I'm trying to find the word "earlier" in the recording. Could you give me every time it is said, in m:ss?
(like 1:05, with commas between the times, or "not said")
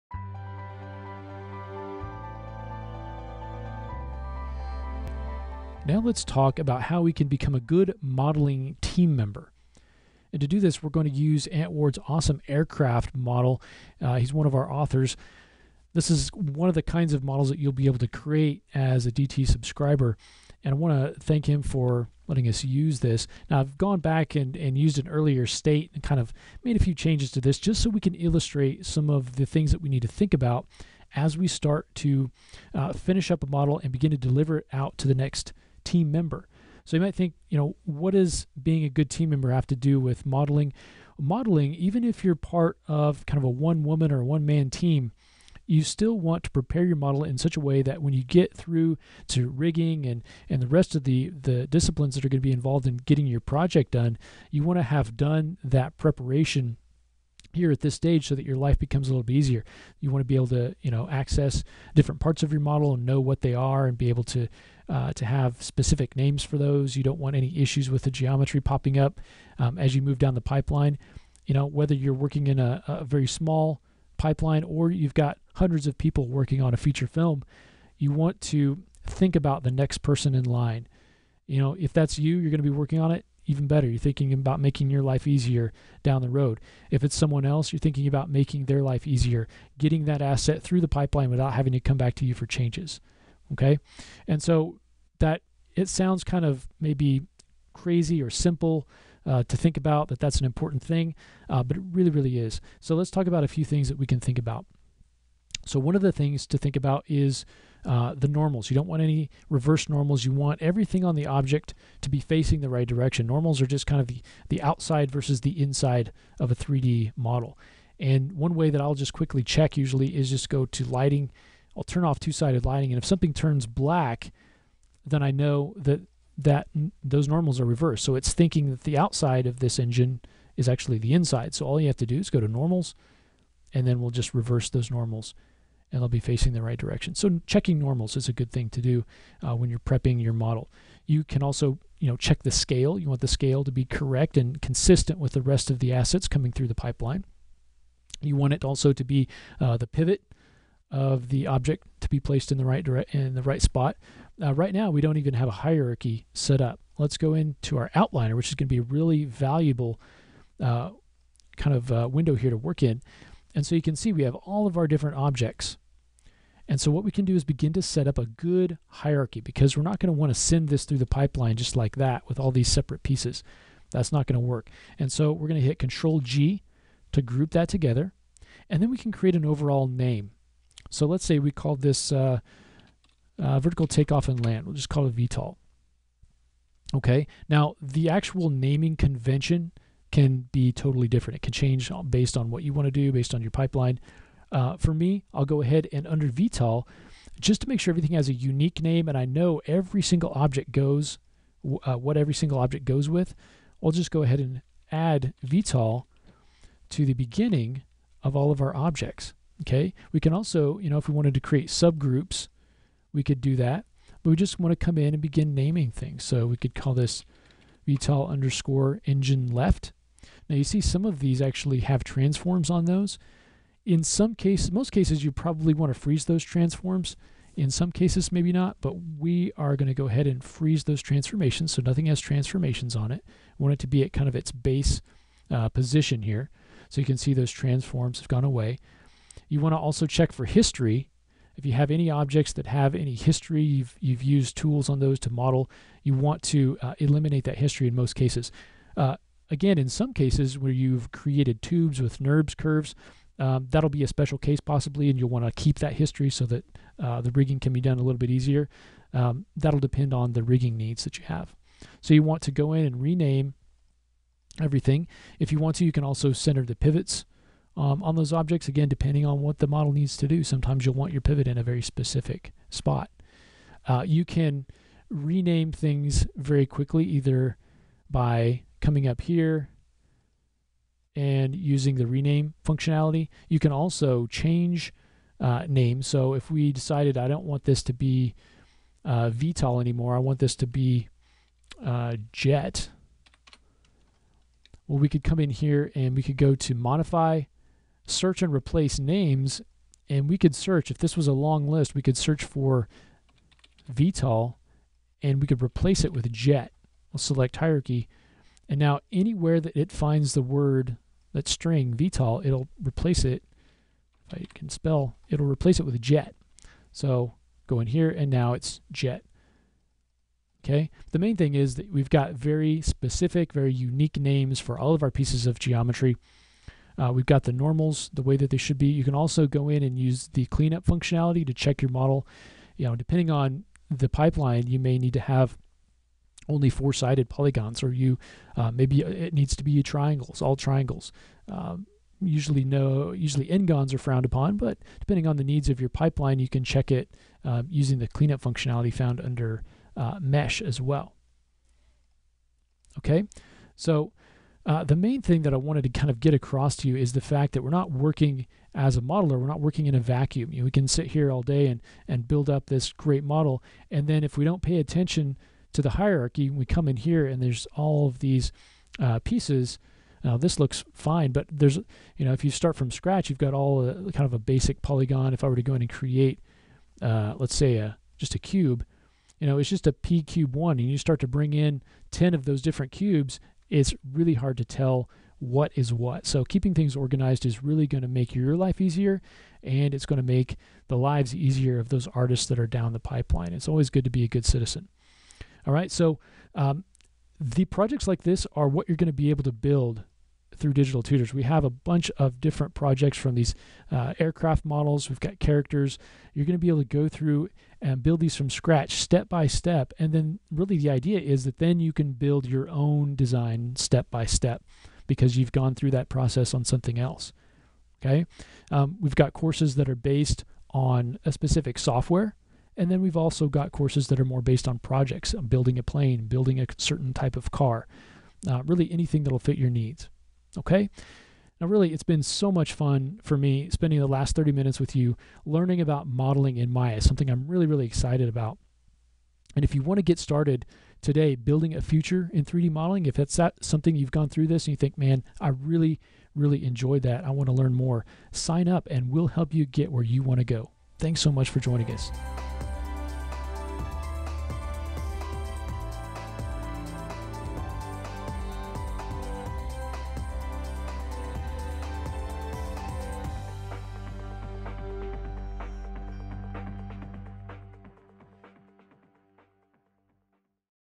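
0:25.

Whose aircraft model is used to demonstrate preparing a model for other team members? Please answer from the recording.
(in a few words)
Ant Ward.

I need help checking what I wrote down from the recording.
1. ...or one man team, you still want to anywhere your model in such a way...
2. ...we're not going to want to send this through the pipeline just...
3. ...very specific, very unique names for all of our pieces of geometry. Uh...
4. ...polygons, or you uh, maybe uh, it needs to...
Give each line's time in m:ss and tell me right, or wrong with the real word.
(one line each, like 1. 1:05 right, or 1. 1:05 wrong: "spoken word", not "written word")
1. 0:44 wrong: "prepare", not "anywhere"
2. 2:49 right
3. 5:22 right
4. 5:37 right.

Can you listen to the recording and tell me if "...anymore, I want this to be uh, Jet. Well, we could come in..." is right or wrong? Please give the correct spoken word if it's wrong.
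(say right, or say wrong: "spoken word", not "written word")
right.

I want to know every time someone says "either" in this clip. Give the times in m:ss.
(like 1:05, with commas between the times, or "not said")
4:37.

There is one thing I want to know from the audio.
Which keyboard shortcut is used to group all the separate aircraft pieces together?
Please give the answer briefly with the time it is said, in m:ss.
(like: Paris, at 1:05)
Control G, at 2:55.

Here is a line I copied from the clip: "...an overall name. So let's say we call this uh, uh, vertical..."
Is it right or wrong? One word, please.
right.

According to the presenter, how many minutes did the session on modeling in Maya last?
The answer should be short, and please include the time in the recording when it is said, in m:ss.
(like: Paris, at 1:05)
30, at 7:14.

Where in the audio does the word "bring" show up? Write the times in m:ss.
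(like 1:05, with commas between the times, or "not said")
6:21.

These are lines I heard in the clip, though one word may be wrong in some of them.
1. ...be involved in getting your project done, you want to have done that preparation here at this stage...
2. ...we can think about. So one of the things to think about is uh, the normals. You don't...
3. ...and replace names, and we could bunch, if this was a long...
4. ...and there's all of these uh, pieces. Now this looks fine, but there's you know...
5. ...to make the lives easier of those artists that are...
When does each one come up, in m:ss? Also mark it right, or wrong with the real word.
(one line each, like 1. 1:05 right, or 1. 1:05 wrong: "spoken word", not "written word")
1. 0:52 right
2. 1:43 right
3. 4:58 wrong: "search", not "bunch"
4. 6:07 right
5. 6:30 right.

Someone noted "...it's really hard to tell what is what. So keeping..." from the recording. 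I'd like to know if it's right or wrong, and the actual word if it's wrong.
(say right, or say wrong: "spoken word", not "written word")
right.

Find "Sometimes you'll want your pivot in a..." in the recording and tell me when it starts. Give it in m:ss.
4:30.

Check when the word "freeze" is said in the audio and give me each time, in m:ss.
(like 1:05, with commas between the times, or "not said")
3:45, 3:50.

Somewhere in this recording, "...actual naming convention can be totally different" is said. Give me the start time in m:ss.
3:08.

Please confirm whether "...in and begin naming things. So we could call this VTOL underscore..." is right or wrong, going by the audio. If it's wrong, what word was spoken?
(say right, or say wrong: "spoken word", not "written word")
right.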